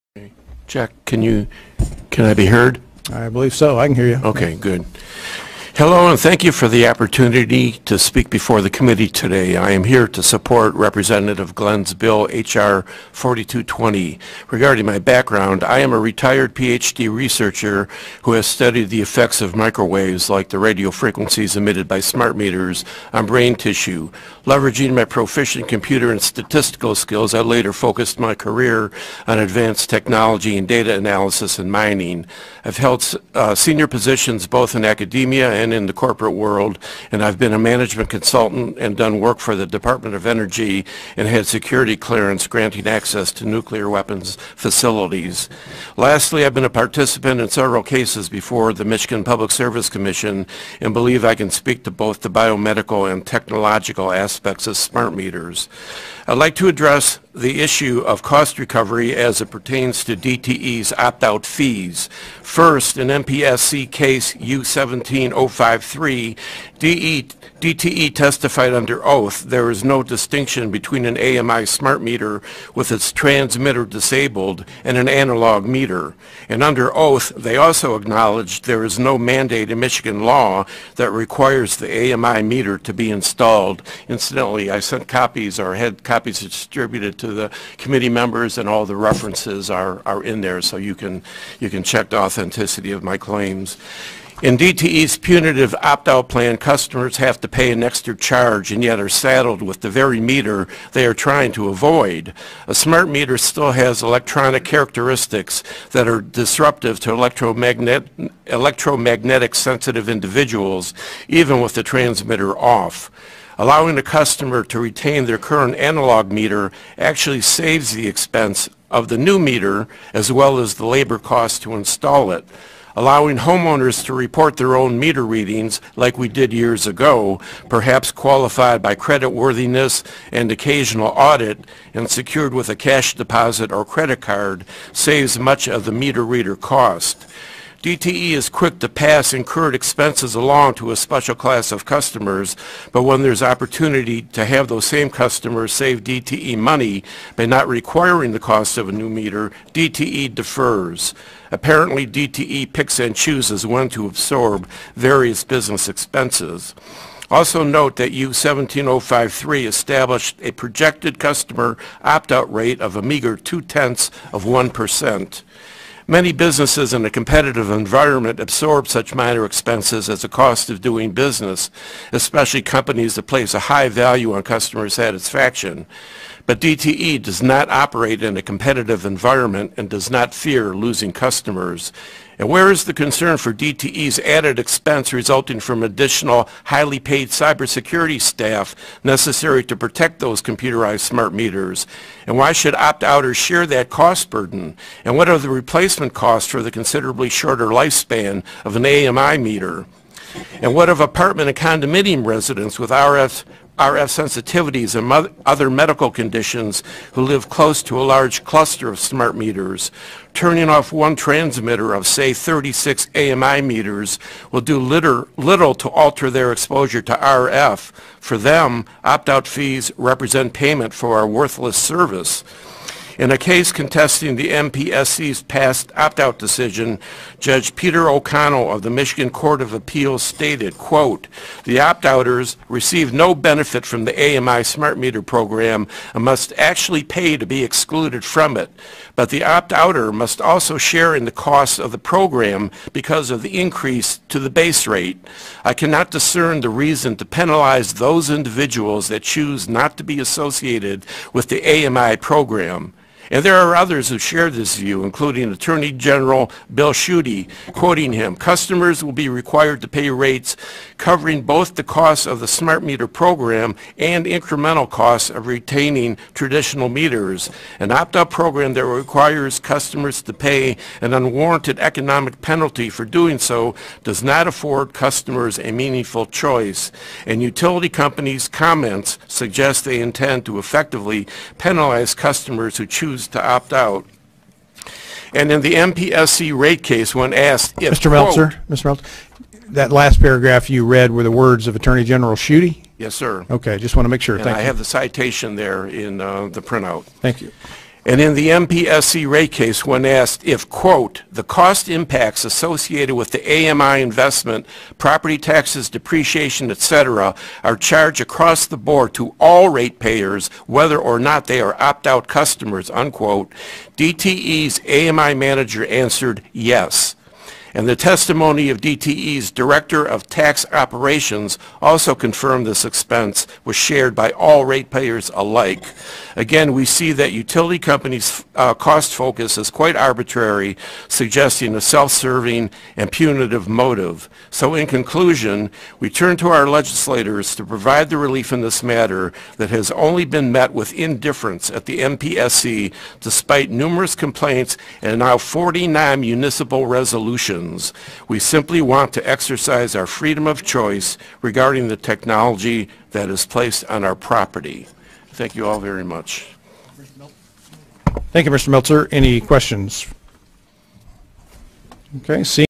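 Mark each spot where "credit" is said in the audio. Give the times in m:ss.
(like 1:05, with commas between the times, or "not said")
2:08, 2:13.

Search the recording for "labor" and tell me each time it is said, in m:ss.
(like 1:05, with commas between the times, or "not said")
2:00.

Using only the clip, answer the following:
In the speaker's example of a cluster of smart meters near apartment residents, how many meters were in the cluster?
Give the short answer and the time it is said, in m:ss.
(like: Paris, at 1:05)
36, at 3:32.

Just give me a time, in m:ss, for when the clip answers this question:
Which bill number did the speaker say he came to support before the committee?
0:12.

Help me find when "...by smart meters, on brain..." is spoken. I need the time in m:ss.
0:21.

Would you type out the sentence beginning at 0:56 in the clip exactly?
I'd like to address the issue of cost recovery as it pertains to DTE's opt-out fees.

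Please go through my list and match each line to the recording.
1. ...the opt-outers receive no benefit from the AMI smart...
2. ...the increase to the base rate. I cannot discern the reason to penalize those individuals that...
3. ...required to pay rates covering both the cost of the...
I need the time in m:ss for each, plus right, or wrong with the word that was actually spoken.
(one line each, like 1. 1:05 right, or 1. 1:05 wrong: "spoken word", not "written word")
1. 3:51 right
2. 4:03 right
3. 4:19 right.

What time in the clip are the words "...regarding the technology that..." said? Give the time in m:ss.
5:51.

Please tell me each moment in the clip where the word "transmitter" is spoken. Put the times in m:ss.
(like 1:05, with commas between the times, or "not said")
1:13, 1:51, 3:31.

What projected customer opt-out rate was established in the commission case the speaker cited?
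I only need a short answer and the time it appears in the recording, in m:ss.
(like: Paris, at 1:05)
two-tenths of 1%, at 2:43.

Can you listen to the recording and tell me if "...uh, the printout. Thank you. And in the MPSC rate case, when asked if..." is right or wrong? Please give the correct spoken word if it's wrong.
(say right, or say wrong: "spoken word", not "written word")
right.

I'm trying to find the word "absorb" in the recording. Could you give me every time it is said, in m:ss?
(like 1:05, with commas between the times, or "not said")
2:34, 2:48.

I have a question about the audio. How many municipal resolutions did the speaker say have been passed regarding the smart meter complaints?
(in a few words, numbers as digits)
49.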